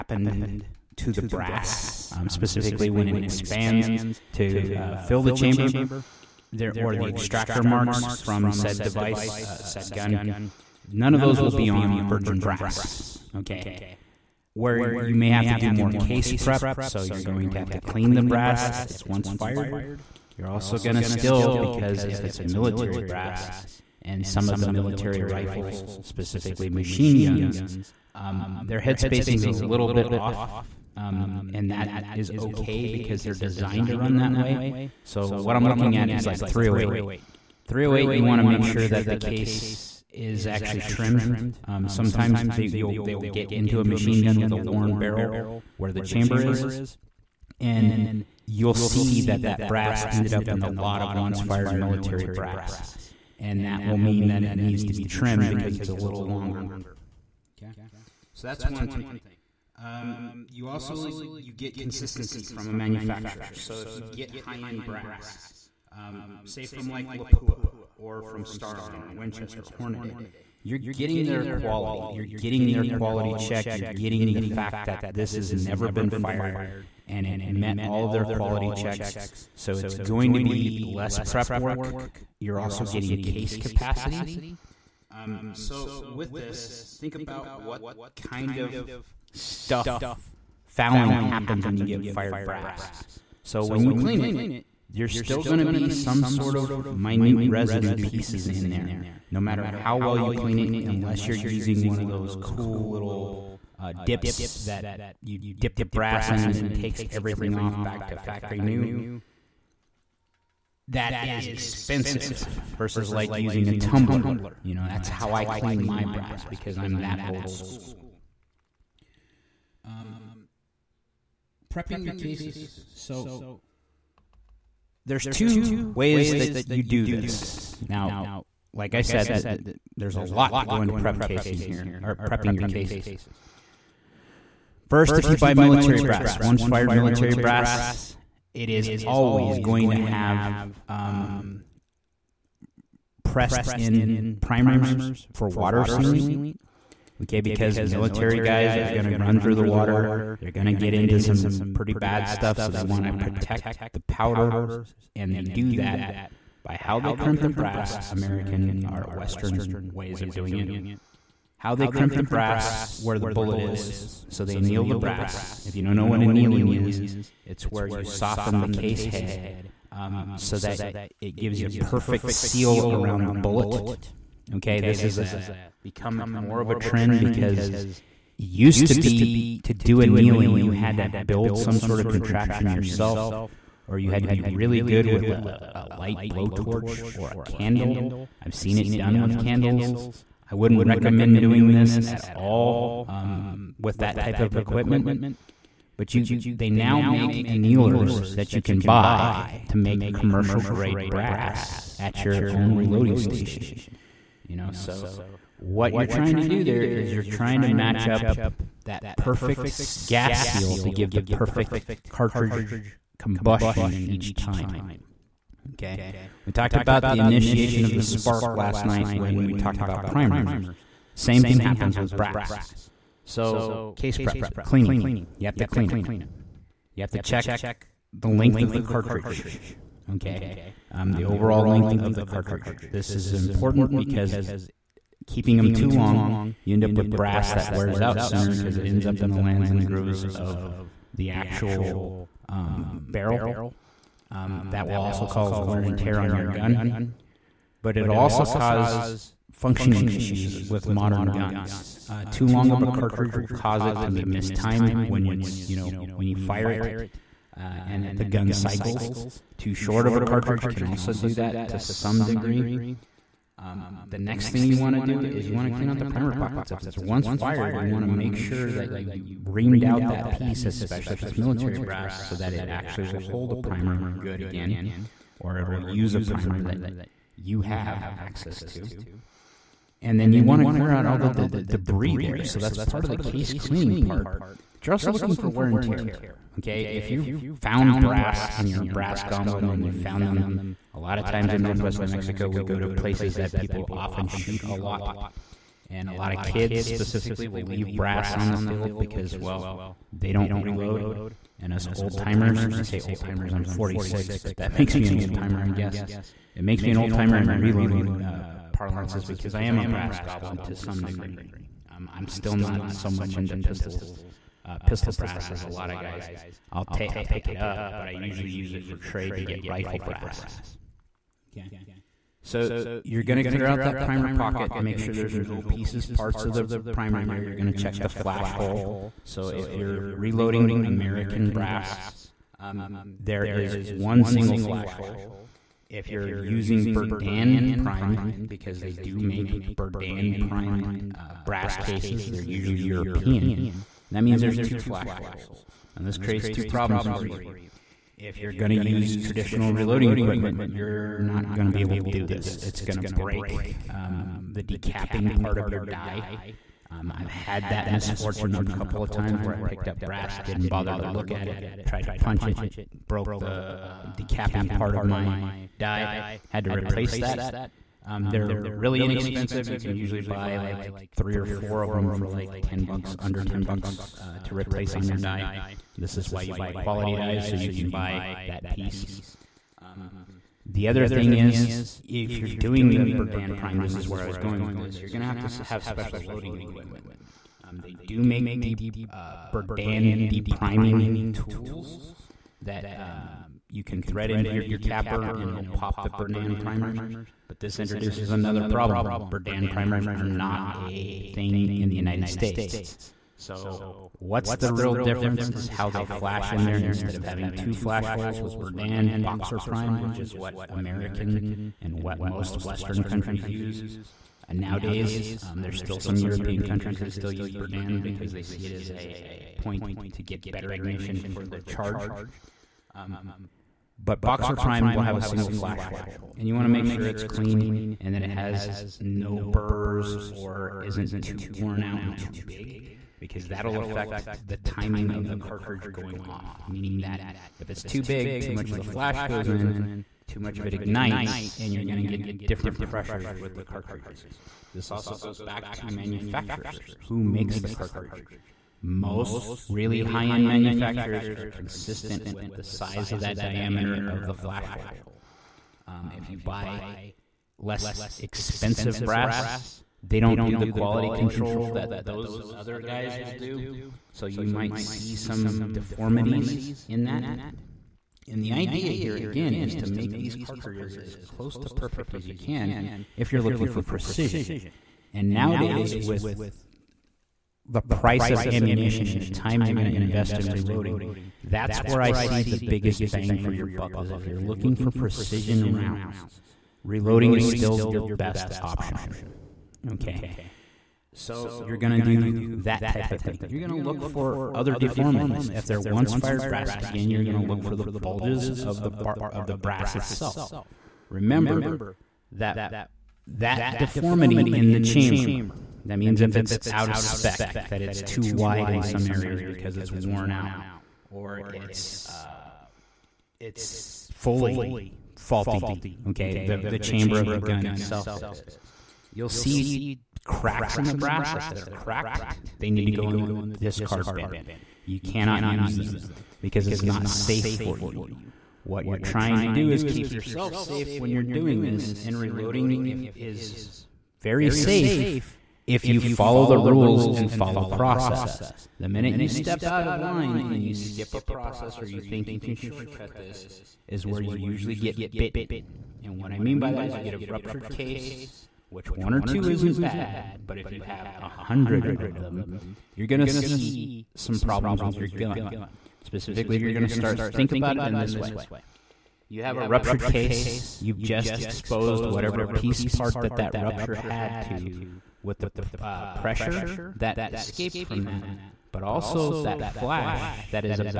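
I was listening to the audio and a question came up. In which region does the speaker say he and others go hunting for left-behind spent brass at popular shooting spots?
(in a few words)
Northwest New Mexico.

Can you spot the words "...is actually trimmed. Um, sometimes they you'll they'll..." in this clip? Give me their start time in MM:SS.
00:40.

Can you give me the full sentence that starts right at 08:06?
Reloading is still your best option.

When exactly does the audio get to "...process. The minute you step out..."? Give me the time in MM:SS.
08:57.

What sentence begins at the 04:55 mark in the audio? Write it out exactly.
And a lot of kids specifically will leave brass on the field because, well, they don't reload.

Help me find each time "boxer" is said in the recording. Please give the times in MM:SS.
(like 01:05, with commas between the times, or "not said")
06:49, 07:04.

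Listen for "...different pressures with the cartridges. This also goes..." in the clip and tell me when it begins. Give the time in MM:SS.
07:22.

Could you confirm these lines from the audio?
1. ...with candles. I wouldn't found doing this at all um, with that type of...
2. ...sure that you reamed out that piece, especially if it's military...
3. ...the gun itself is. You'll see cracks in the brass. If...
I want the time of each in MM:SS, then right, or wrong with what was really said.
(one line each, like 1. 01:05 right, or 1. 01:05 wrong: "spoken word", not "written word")
1. 03:09 wrong: "recommend", not "found"
2. 04:28 right
3. 08:37 right.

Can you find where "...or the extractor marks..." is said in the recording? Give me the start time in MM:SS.
00:06.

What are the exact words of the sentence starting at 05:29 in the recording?
So if you're reloading American brass, um, there is one single flash hole.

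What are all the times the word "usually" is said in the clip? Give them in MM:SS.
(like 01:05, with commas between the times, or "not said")
05:18, 05:42, 06:09, 09:04.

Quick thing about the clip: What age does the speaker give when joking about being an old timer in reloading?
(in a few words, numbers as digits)
46.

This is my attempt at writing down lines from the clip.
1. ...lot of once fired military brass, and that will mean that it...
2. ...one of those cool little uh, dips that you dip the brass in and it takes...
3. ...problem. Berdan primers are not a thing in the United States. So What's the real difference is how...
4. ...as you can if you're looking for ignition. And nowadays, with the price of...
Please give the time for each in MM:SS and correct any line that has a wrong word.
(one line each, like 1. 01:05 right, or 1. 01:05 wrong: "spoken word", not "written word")
1. 00:50 right
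2. 01:41 right
3. 06:38 right
4. 07:52 wrong: "precision", not "ignition".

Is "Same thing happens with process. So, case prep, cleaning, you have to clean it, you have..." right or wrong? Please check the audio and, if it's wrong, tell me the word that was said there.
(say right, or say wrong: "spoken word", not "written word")
wrong: "brass", not "process".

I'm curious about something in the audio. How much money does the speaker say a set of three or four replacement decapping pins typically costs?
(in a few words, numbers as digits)
Under 10 dollars.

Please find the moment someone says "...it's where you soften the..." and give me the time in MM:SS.
02:47.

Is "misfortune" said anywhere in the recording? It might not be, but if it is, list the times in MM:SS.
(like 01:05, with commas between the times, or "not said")
05:57.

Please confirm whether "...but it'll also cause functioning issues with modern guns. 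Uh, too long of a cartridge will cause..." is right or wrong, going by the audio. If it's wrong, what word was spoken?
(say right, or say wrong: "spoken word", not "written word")
right.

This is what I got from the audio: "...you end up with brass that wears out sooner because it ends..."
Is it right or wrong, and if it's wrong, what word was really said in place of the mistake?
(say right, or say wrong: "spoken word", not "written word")
right.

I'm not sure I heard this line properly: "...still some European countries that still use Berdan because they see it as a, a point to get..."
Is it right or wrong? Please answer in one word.
right.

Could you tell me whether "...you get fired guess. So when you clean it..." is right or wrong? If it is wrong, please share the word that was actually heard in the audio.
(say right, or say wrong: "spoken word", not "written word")
wrong: "brass", not "guess".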